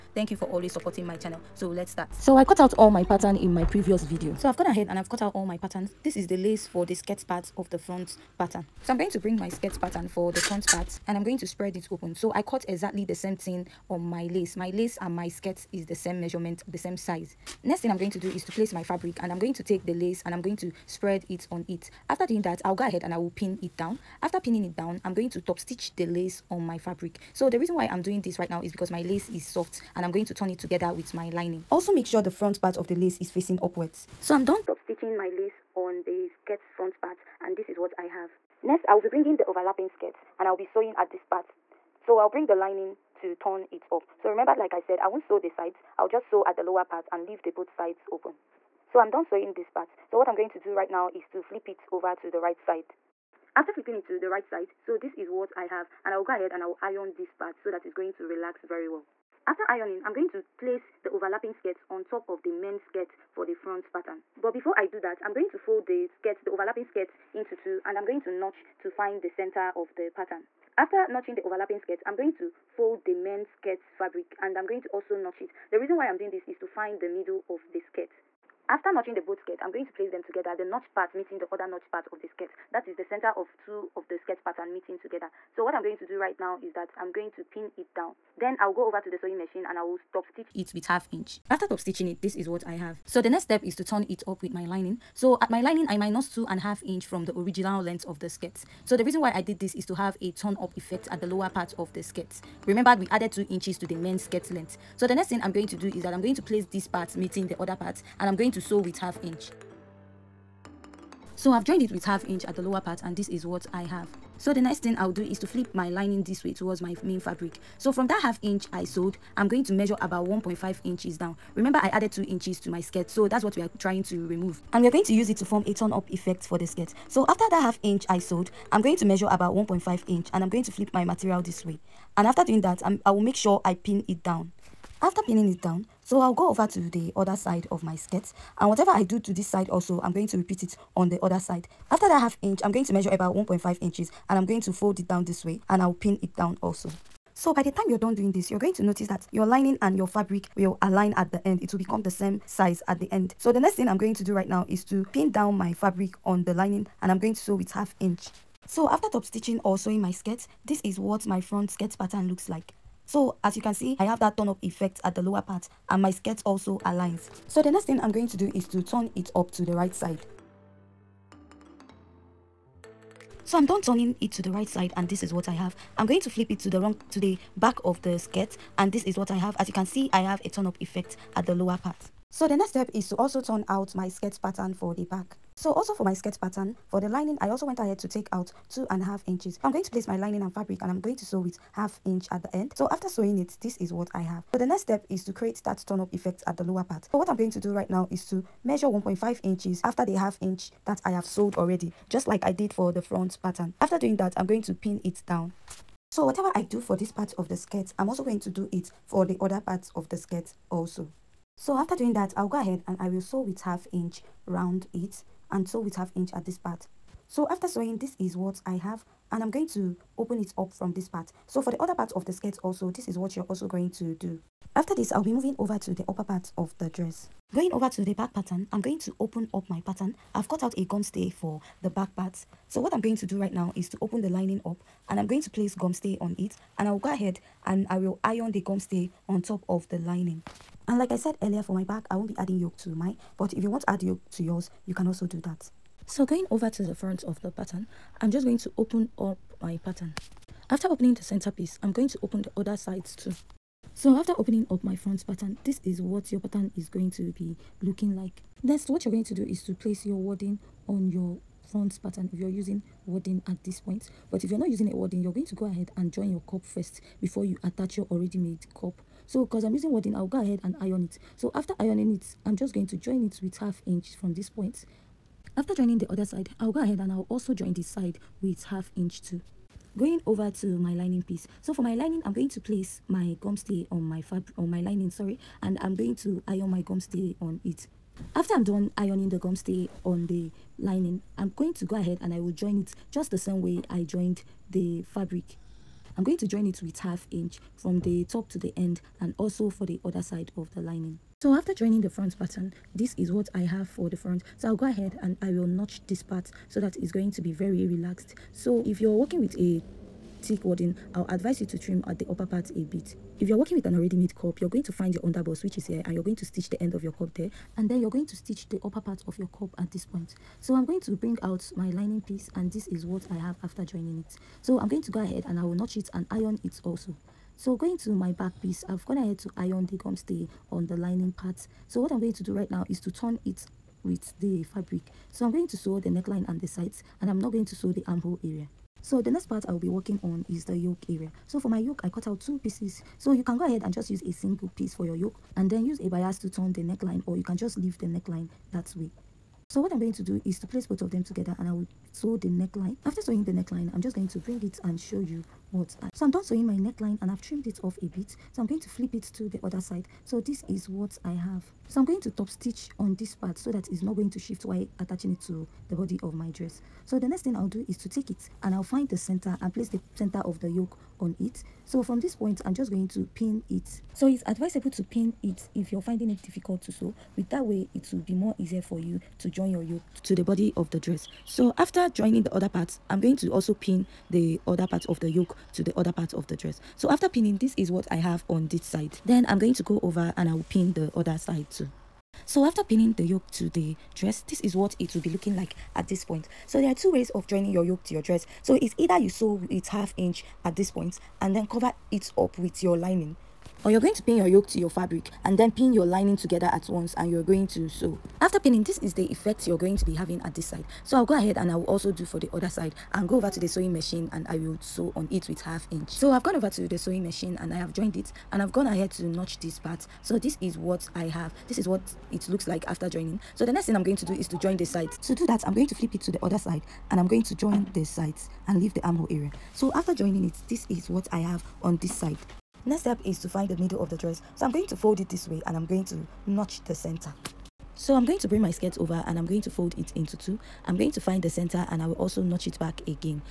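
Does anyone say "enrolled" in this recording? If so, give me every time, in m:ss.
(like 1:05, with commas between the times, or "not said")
not said.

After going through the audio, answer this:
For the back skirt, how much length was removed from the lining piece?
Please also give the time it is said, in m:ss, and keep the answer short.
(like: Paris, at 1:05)
2.5 inches, at 3:08.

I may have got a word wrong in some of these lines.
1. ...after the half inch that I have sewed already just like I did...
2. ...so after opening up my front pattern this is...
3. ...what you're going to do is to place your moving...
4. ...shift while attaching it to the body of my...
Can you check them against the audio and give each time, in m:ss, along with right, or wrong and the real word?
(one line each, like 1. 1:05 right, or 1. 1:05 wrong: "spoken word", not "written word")
1. 3:19 right
2. 4:13 right
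3. 4:18 wrong: "wadding", not "moving"
4. 6:04 right.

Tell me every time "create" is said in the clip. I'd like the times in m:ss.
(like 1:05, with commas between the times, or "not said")
3:15.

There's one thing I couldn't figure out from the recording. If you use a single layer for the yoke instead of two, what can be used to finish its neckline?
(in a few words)
a bias.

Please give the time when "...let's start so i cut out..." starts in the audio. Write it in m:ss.
0:01.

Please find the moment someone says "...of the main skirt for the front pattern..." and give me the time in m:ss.
1:02.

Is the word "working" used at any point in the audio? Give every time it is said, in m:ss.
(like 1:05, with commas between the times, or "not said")
5:09, 5:13, 5:39.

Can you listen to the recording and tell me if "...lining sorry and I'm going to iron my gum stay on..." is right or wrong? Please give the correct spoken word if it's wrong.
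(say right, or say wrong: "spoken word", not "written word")
right.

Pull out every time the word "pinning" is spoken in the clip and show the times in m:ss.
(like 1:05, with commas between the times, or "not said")
0:24, 2:15, 6:27, 6:32, 6:48.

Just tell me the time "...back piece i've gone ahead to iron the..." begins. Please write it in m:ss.
5:28.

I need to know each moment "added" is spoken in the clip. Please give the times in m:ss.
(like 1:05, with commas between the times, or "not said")
1:43, 2:01.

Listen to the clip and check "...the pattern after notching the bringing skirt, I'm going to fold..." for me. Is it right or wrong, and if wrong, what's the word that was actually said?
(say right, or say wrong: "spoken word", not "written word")
wrong: "overlapping", not "bringing".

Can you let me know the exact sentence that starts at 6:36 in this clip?
So there are two ways of joining your yoke to your dress.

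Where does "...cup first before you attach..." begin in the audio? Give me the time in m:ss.
4:26.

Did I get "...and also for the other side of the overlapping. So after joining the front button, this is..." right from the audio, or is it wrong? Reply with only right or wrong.
wrong.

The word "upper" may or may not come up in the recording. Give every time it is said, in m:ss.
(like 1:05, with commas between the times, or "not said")
3:46, 5:12, 5:18.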